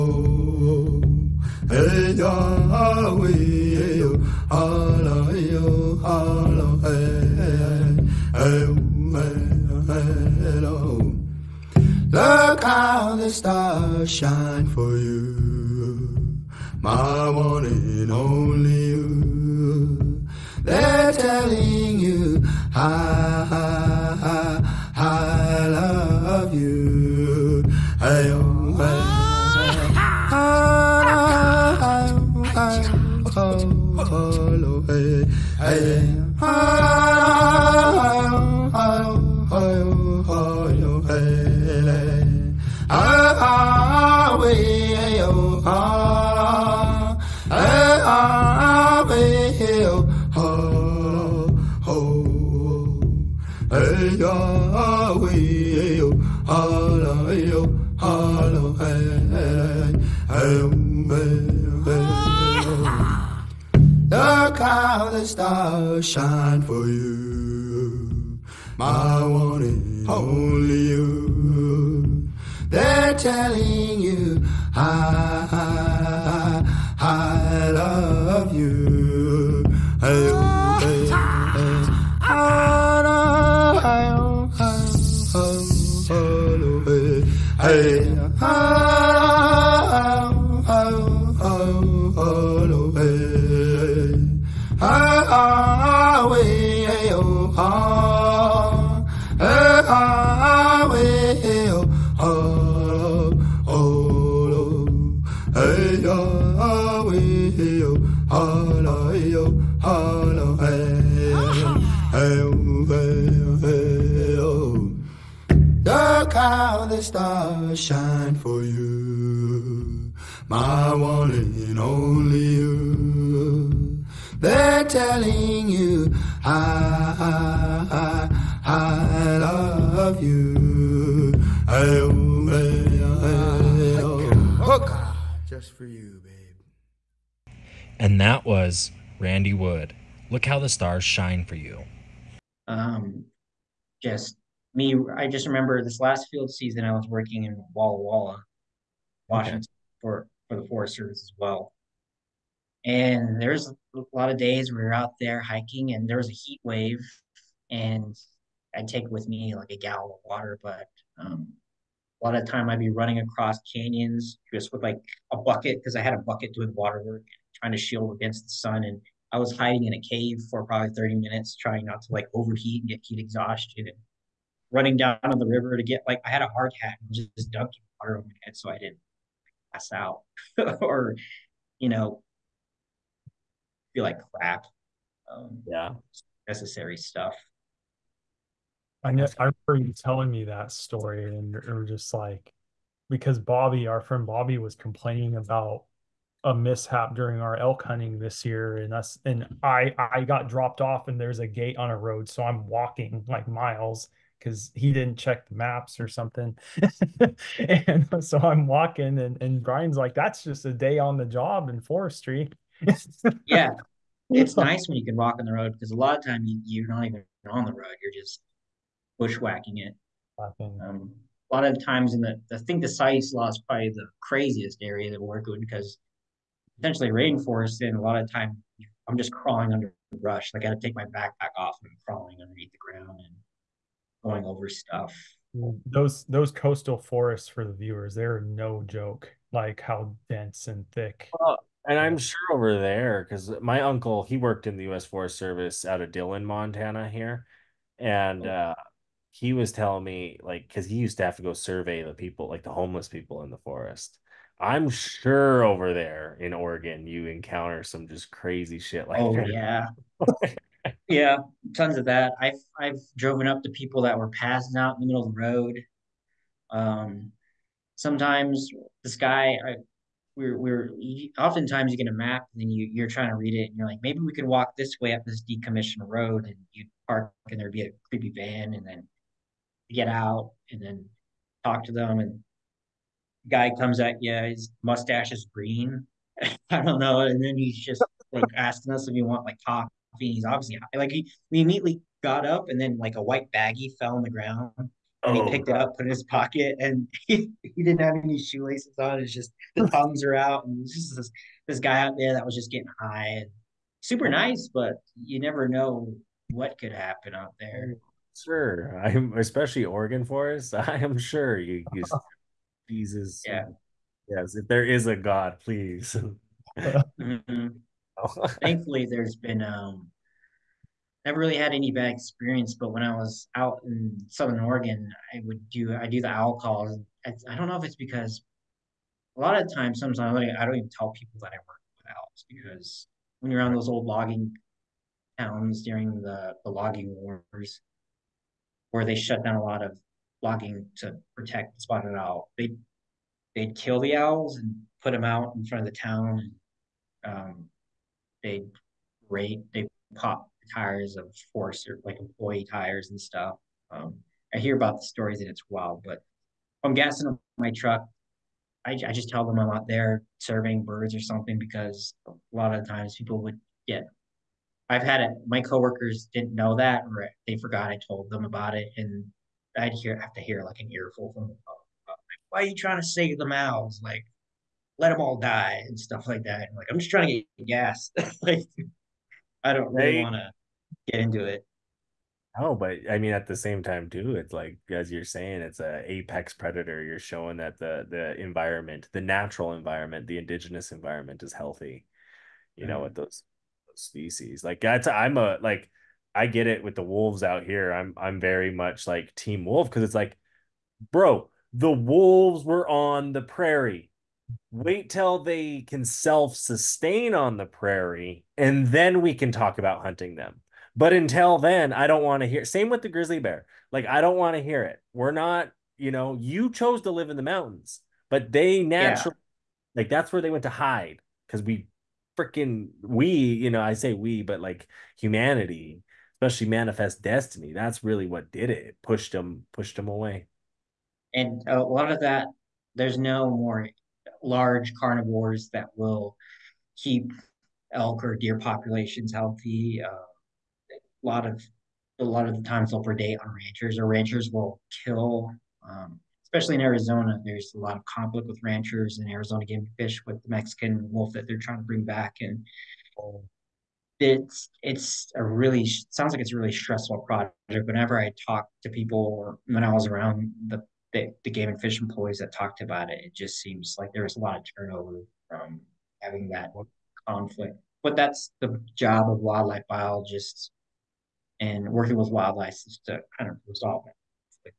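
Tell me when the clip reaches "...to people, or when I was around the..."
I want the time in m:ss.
7:38.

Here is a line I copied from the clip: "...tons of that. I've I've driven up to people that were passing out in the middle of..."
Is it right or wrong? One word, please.
right.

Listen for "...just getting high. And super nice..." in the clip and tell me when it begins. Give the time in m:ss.
5:02.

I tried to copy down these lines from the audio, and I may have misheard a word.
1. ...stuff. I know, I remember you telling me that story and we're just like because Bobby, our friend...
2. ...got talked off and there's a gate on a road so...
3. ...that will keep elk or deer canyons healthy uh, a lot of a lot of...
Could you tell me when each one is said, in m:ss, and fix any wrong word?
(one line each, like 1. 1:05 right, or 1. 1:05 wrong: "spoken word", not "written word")
1. 3:06 right
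2. 3:20 wrong: "dropped", not "talked"
3. 7:15 wrong: "populations", not "canyons".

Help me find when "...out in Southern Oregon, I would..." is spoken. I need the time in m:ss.
5:23.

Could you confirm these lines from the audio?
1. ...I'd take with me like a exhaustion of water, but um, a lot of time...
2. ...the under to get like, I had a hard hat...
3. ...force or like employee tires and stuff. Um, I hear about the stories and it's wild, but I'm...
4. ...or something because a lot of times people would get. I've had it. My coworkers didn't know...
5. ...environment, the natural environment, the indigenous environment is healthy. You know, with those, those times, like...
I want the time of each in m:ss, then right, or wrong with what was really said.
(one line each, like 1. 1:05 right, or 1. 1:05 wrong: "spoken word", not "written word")
1. 2:38 wrong: "gallon", not "exhaustion"
2. 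2:55 wrong: "river", not "under"
3. 5:51 right
4. 6:01 right
5. 6:28 wrong: "species", not "times".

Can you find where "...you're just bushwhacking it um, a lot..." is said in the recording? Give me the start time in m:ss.
3:38.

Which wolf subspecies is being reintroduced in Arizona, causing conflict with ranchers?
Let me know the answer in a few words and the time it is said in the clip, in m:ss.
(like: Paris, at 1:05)
Mexican wolf, at 7:30.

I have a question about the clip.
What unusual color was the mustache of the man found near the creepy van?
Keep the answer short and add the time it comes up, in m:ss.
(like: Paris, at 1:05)
green, at 4:45.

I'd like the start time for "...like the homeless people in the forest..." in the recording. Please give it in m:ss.
4:12.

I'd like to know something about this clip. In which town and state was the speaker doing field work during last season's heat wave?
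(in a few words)
Walla Walla, Washington.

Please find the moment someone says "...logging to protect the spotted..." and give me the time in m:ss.
5:40.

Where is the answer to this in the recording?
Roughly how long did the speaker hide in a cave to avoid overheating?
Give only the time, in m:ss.
2:50.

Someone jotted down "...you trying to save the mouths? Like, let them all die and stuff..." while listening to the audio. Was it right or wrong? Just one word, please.
right.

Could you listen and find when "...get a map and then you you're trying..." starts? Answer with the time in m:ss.
4:31.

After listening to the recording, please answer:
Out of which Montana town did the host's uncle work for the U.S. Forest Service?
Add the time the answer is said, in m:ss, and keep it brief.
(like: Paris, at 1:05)
Dillon, Montana, at 4:06.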